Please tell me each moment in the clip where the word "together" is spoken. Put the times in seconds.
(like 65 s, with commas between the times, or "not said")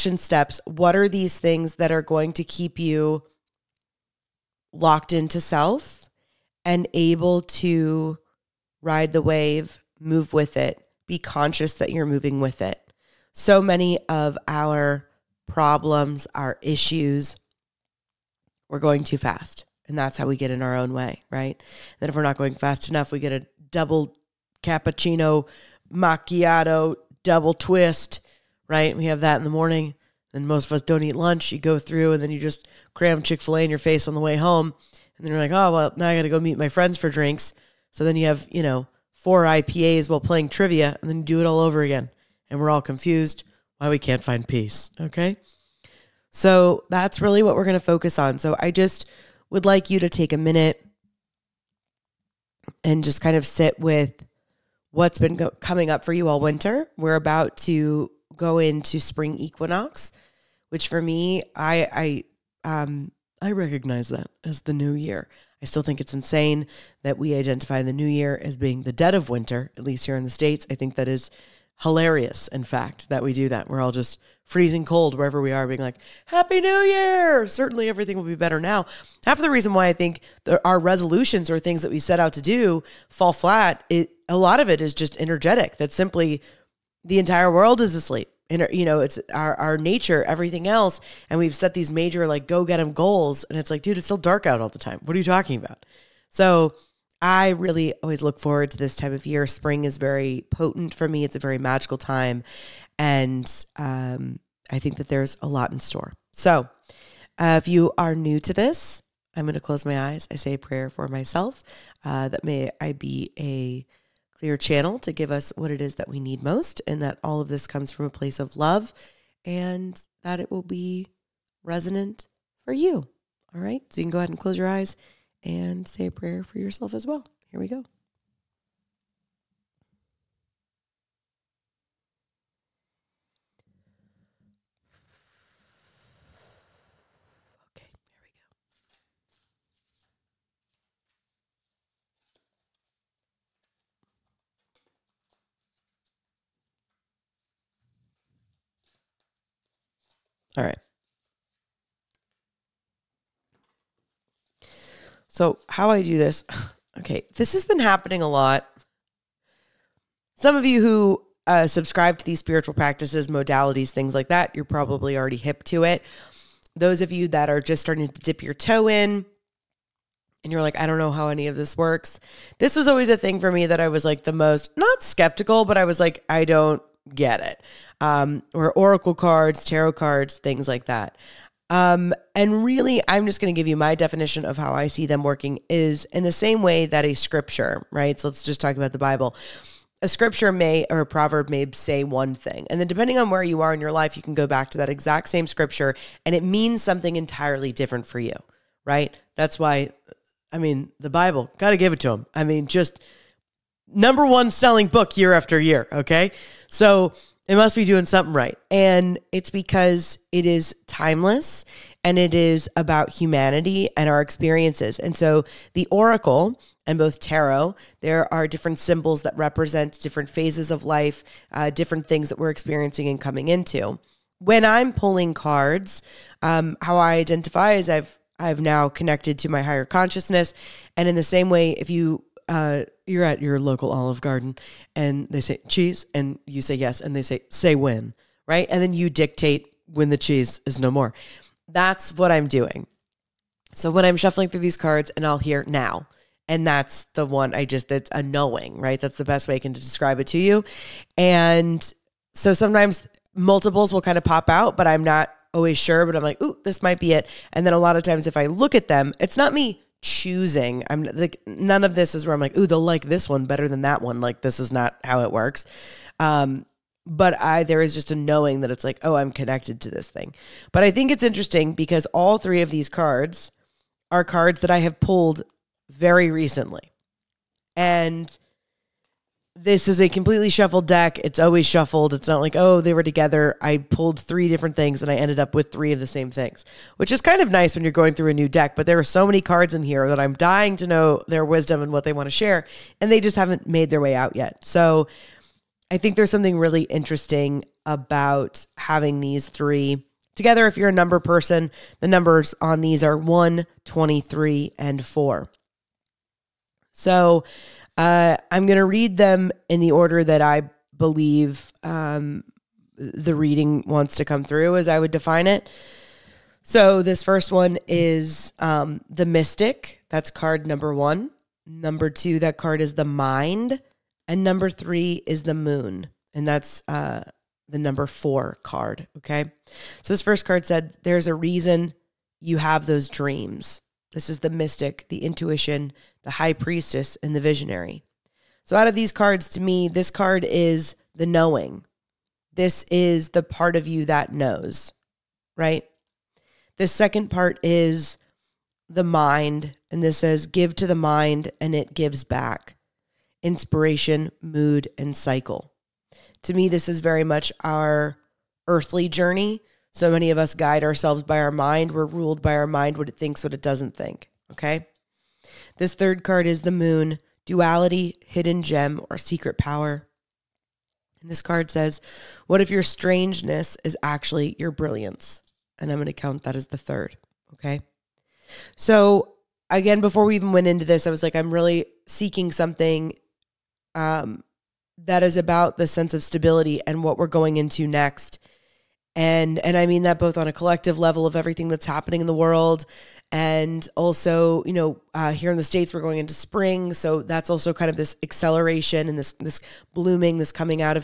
283 s, 300 s.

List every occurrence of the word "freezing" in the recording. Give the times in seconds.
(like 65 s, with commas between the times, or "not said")
74 s.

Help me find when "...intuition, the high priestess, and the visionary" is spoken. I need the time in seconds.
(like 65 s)
335 s.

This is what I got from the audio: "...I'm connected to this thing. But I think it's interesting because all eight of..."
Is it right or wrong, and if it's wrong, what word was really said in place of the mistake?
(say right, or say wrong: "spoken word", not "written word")
wrong: "three", not "eight".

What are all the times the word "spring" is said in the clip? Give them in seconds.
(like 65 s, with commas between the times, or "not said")
59 s, 99 s, 396 s.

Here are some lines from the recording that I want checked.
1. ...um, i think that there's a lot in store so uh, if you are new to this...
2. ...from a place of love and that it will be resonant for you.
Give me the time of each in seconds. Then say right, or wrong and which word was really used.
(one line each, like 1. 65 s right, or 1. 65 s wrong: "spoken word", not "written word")
1. 103 s right
2. 117 s right.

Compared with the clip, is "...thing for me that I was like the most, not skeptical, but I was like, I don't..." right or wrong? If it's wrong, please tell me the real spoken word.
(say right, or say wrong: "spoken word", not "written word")
right.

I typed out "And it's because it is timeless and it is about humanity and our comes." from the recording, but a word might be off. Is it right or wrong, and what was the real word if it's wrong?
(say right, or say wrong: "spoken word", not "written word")
wrong: "experiences", not "comes".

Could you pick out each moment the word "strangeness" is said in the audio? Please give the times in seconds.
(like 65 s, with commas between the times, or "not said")
372 s.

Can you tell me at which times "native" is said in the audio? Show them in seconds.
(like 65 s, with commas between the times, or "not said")
not said.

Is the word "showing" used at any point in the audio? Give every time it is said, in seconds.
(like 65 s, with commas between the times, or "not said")
not said.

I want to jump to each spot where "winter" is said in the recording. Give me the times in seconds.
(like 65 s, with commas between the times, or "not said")
56 s, 69 s.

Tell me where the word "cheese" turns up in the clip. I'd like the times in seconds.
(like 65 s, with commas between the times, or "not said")
235 s, 240 s.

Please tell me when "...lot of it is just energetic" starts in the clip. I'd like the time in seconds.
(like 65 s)
84 s.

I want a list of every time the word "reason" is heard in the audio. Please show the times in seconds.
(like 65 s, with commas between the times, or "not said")
79 s, 331 s.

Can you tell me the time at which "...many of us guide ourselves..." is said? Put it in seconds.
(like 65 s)
360 s.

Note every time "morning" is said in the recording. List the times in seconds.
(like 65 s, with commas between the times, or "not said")
29 s.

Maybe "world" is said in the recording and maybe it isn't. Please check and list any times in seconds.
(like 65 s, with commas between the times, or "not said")
87 s, 392 s.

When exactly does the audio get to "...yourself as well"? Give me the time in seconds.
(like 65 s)
126 s.